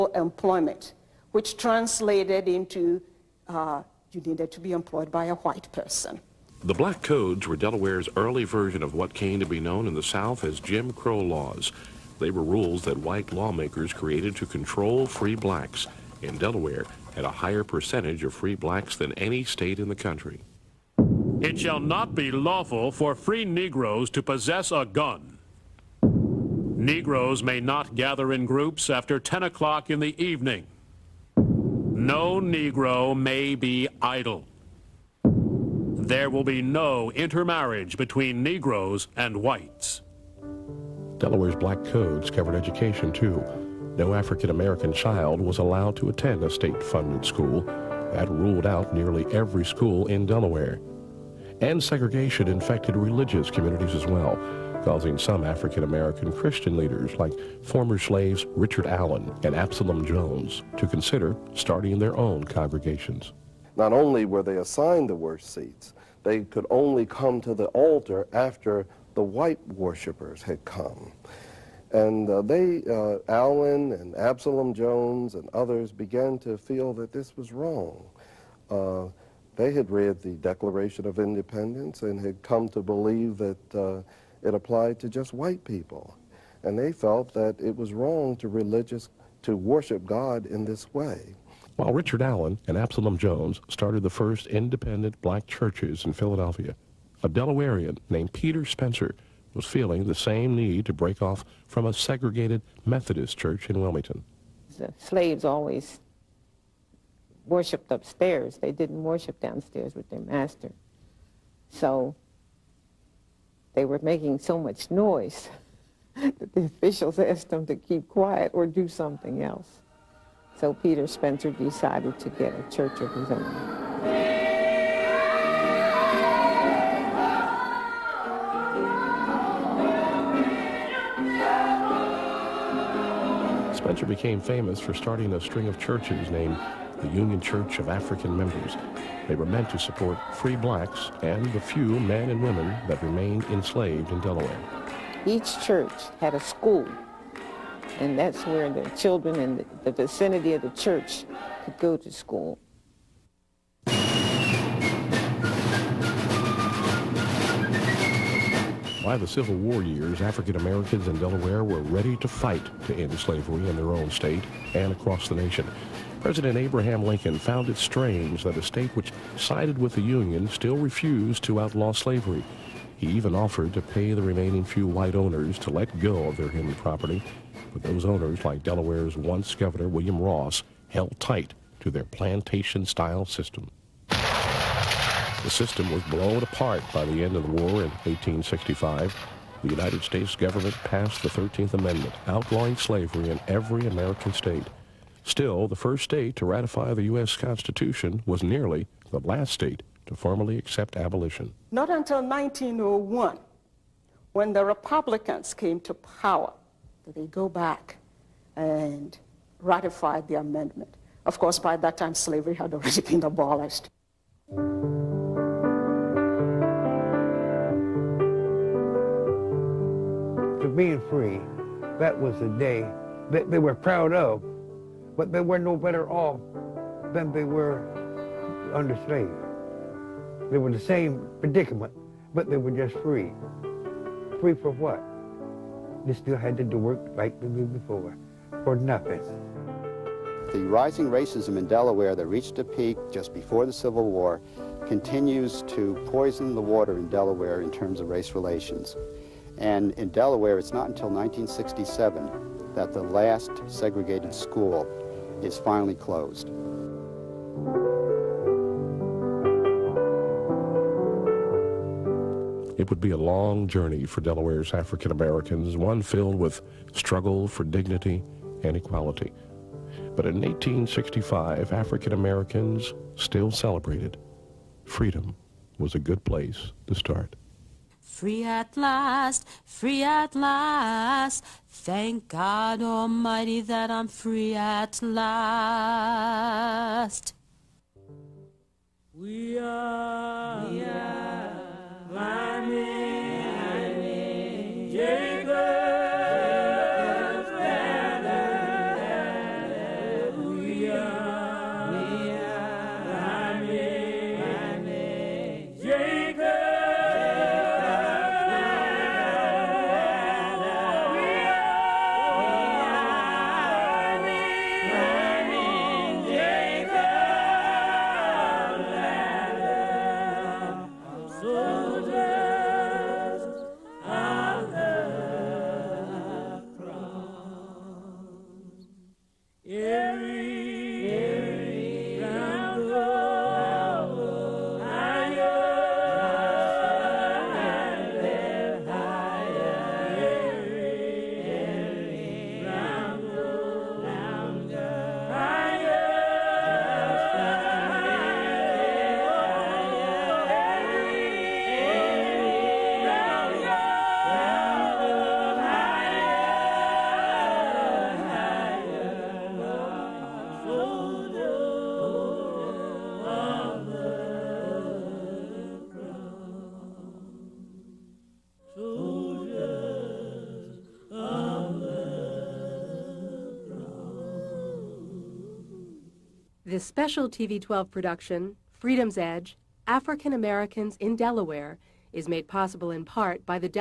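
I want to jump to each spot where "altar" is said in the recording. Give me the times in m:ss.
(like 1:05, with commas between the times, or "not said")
1:07.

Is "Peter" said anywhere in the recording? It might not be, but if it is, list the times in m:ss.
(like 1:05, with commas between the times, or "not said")
1:38, 2:00.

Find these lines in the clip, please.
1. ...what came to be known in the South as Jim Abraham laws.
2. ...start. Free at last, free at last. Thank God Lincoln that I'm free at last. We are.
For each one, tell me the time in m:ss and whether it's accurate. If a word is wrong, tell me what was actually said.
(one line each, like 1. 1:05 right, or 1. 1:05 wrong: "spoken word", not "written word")
1. 0:08 wrong: "Crow", not "Abraham"
2. 4:36 wrong: "Almighty", not "Lincoln".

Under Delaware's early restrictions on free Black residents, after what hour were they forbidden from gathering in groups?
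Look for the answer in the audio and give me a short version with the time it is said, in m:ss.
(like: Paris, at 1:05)
10 o'clock, at 0:29.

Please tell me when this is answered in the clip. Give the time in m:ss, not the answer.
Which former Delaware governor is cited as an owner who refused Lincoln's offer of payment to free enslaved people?
2:59.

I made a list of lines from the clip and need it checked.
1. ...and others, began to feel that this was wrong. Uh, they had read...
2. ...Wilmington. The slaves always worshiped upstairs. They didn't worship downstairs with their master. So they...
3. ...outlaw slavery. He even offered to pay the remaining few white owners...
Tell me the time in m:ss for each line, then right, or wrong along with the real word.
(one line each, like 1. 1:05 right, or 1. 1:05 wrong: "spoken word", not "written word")
1. 1:15 right
2. 1:43 right
3. 2:51 right.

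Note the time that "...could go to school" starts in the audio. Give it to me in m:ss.
2:31.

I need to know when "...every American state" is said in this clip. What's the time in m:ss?
3:13.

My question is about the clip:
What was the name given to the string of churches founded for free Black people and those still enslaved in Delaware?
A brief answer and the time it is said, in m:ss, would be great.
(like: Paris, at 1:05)
Union Church of African members, at 2:17.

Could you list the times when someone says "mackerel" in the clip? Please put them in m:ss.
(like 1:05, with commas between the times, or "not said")
not said.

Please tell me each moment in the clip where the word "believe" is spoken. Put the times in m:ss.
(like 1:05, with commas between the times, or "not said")
1:22.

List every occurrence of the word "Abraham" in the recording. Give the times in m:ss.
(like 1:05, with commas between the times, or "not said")
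2:46.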